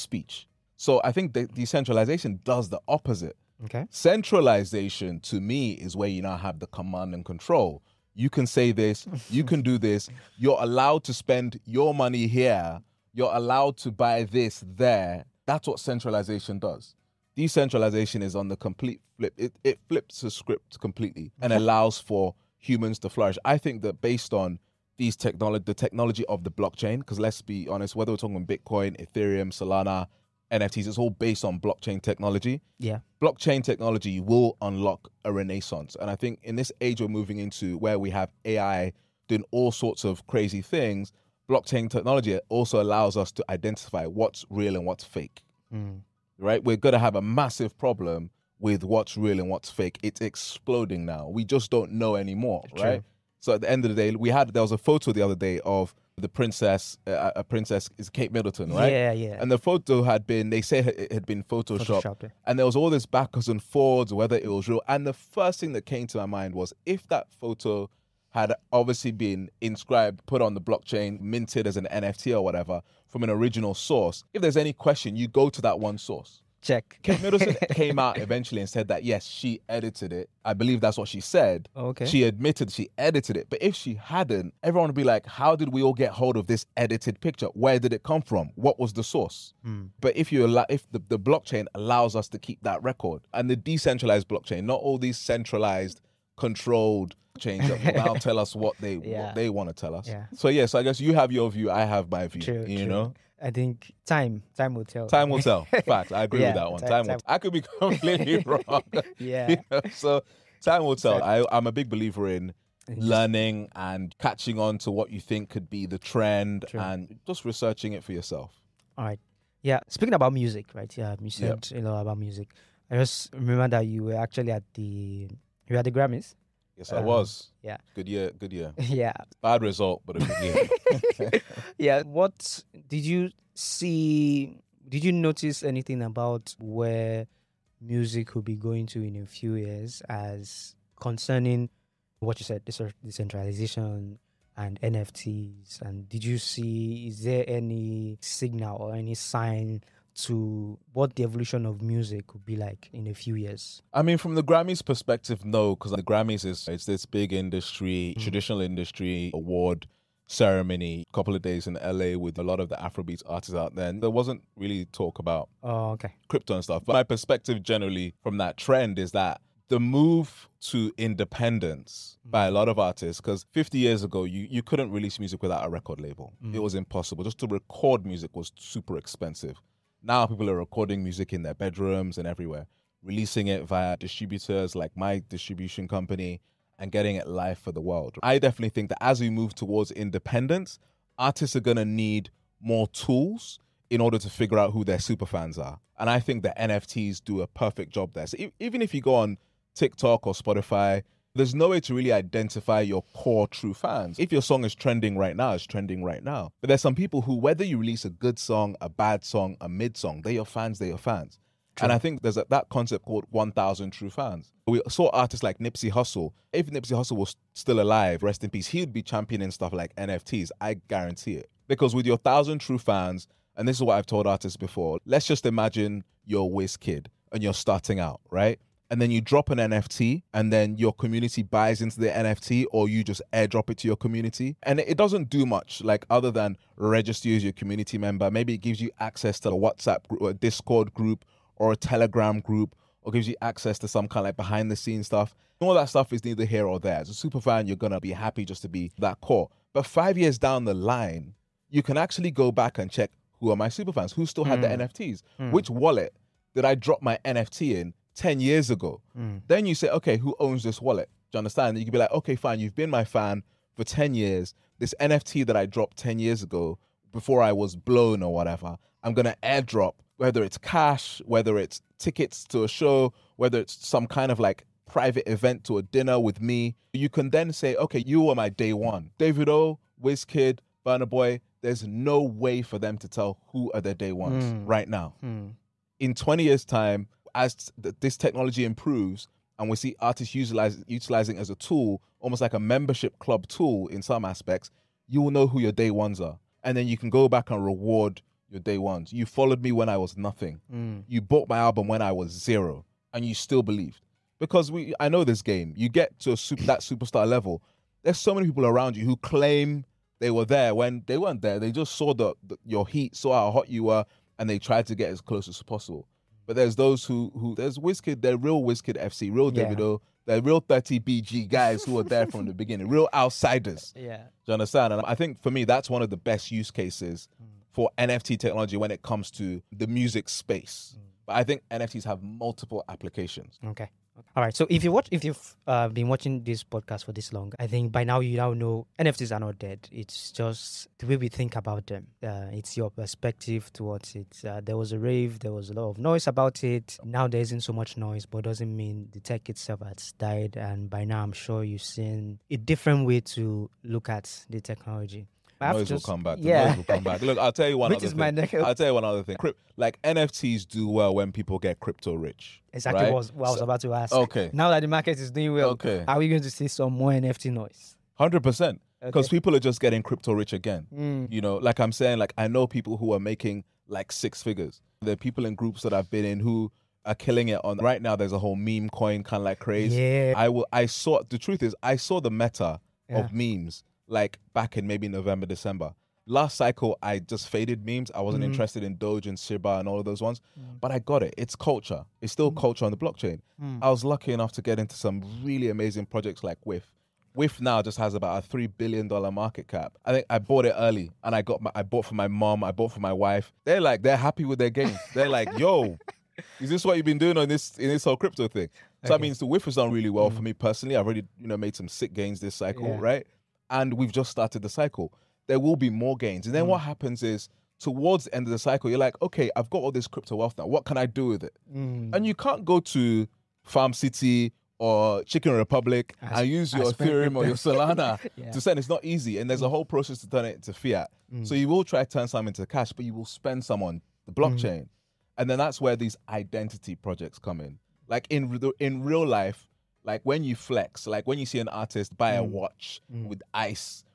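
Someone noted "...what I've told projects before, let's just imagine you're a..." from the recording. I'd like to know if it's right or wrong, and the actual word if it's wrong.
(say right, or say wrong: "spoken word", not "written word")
wrong: "artists", not "projects".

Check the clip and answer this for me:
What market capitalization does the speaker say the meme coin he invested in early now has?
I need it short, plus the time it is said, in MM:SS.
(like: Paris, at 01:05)
3 billion dollars, at 06:38.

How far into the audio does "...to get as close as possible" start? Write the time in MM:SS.
05:14.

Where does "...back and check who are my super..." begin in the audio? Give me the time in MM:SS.
04:12.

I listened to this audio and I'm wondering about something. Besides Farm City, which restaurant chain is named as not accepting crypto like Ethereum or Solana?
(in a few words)
Chicken Republic.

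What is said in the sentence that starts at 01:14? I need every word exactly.
If there's any question, you go to that one source check.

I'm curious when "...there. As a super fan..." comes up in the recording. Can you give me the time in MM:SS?
04:06.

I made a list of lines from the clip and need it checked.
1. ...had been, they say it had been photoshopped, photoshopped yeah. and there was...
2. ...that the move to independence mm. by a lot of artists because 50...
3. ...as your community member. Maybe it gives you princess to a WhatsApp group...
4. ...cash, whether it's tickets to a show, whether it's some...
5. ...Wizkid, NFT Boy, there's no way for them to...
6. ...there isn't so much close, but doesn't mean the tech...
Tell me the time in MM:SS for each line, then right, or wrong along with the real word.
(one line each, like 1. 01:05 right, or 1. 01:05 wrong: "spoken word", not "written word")
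1. 01:00 right
2. 02:49 right
3. 03:57 wrong: "access", not "princess"
4. 04:30 right
5. 04:40 wrong: "Burna", not "NFT"
6. 05:47 wrong: "noise", not "close".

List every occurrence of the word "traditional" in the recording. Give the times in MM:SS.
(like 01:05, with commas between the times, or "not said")
02:38.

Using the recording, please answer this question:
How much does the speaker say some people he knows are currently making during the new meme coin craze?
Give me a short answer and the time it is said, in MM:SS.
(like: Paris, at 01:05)
six figures, at 06:14.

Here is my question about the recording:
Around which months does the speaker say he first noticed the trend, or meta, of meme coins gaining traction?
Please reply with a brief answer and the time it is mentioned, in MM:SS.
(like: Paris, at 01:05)
November, December, at 06:25.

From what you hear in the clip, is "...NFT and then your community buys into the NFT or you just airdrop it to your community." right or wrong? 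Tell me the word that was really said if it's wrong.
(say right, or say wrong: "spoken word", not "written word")
right.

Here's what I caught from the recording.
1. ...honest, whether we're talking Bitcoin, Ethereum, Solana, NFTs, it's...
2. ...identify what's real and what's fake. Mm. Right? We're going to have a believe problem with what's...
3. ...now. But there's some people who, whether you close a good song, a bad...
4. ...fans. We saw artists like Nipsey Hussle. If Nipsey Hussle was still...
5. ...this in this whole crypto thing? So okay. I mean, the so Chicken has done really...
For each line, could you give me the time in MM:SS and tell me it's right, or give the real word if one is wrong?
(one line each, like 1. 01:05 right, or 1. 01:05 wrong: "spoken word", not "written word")
1. 00:27 right
2. 00:43 wrong: "massive", not "believe"
3. 03:26 wrong: "release", not "close"
4. 03:34 right
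5. 06:47 wrong: "WIF", not "Chicken".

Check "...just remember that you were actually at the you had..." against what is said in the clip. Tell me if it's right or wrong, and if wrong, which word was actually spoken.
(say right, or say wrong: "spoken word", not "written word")
right.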